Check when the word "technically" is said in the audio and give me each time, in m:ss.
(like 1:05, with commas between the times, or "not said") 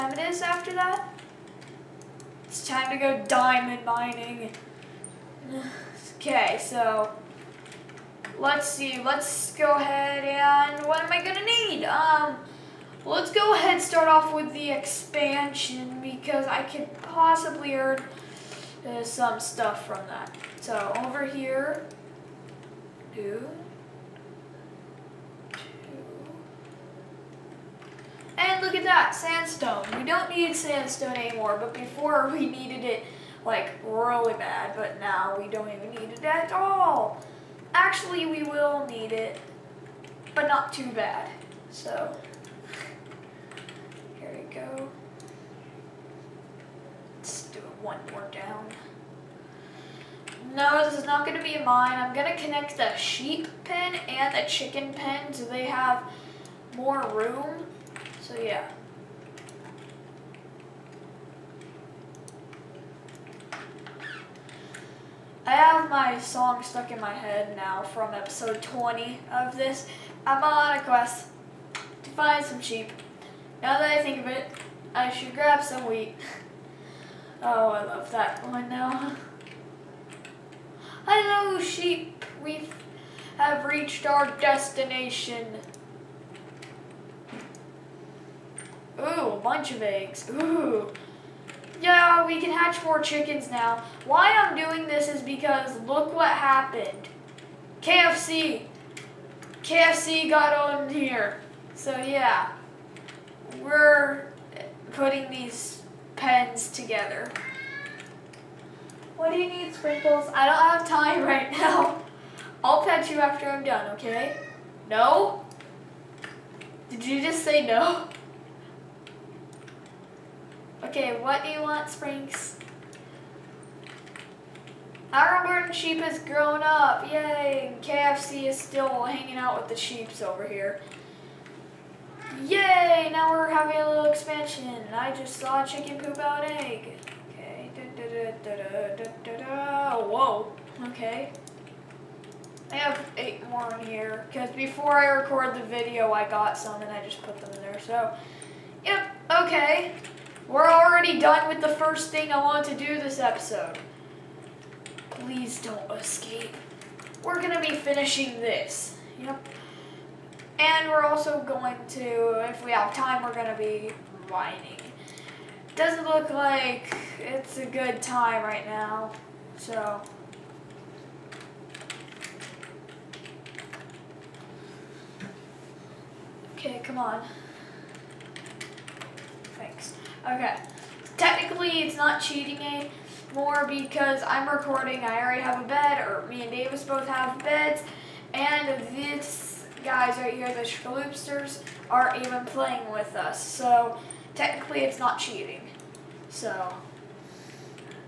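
3:01, 3:14.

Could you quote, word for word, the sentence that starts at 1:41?
So, yeah we're putting these pens together.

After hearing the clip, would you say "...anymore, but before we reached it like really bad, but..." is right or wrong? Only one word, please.
wrong.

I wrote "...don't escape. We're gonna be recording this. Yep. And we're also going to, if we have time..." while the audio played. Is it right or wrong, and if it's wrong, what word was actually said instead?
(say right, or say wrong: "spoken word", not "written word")
wrong: "finishing", not "recording".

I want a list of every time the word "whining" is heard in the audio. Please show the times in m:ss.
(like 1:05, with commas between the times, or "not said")
2:44.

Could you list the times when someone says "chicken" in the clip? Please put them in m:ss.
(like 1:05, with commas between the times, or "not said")
0:54, 1:33, 2:15.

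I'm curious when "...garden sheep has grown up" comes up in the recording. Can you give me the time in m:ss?
2:05.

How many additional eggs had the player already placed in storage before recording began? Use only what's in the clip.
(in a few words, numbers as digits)
8.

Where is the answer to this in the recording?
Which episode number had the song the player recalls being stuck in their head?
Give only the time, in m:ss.
1:08.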